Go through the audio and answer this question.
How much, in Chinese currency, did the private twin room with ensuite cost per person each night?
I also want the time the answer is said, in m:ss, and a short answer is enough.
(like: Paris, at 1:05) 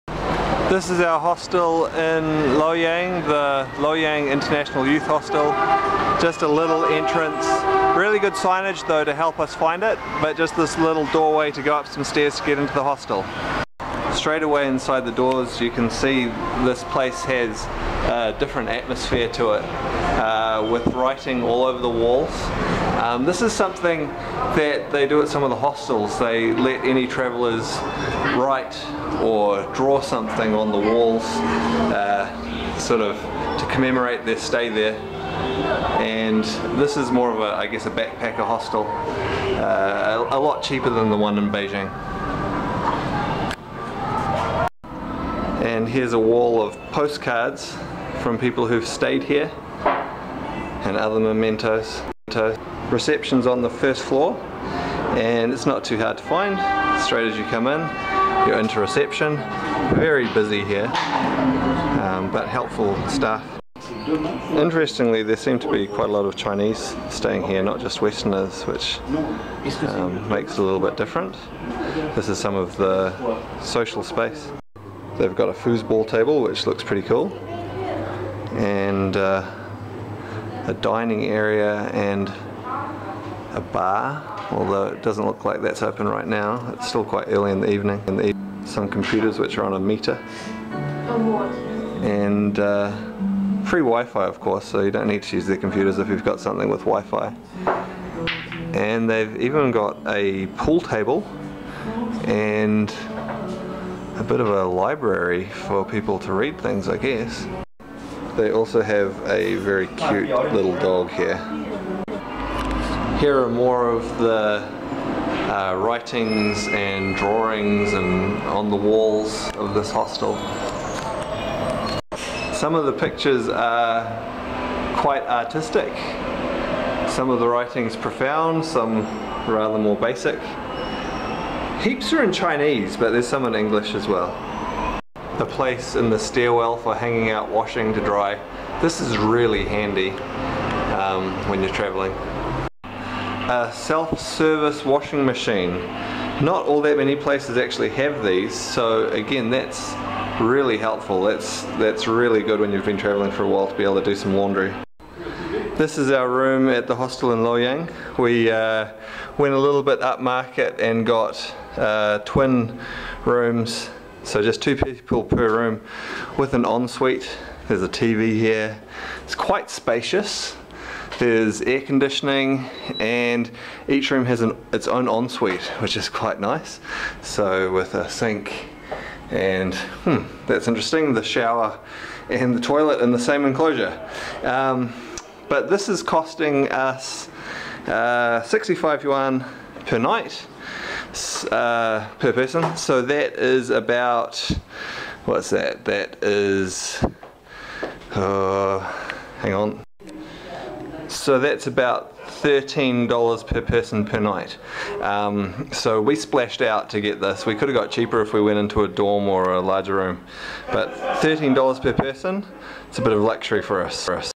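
65 yuan, at 3:08.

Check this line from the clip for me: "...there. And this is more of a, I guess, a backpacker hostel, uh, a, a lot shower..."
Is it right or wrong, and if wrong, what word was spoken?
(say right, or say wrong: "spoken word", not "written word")
wrong: "cheaper", not "shower".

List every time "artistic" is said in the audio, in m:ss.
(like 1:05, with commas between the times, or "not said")
2:05.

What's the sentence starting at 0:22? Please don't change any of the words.
Um, this is something that they do at some of the hostels.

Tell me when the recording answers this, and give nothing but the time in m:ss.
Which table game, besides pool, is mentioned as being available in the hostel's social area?
1:15.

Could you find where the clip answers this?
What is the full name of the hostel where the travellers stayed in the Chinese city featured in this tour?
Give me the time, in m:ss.
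0:03.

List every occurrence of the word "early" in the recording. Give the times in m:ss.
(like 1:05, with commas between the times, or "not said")
1:27.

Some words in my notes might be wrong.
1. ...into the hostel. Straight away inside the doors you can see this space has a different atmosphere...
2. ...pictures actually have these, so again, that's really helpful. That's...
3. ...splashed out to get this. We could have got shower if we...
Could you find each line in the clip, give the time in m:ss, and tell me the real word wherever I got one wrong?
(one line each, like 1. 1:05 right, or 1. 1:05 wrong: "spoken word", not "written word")
1. 0:12 wrong: "place", not "space"
2. 2:27 wrong: "places", not "pictures"
3. 3:26 wrong: "cheaper", not "shower".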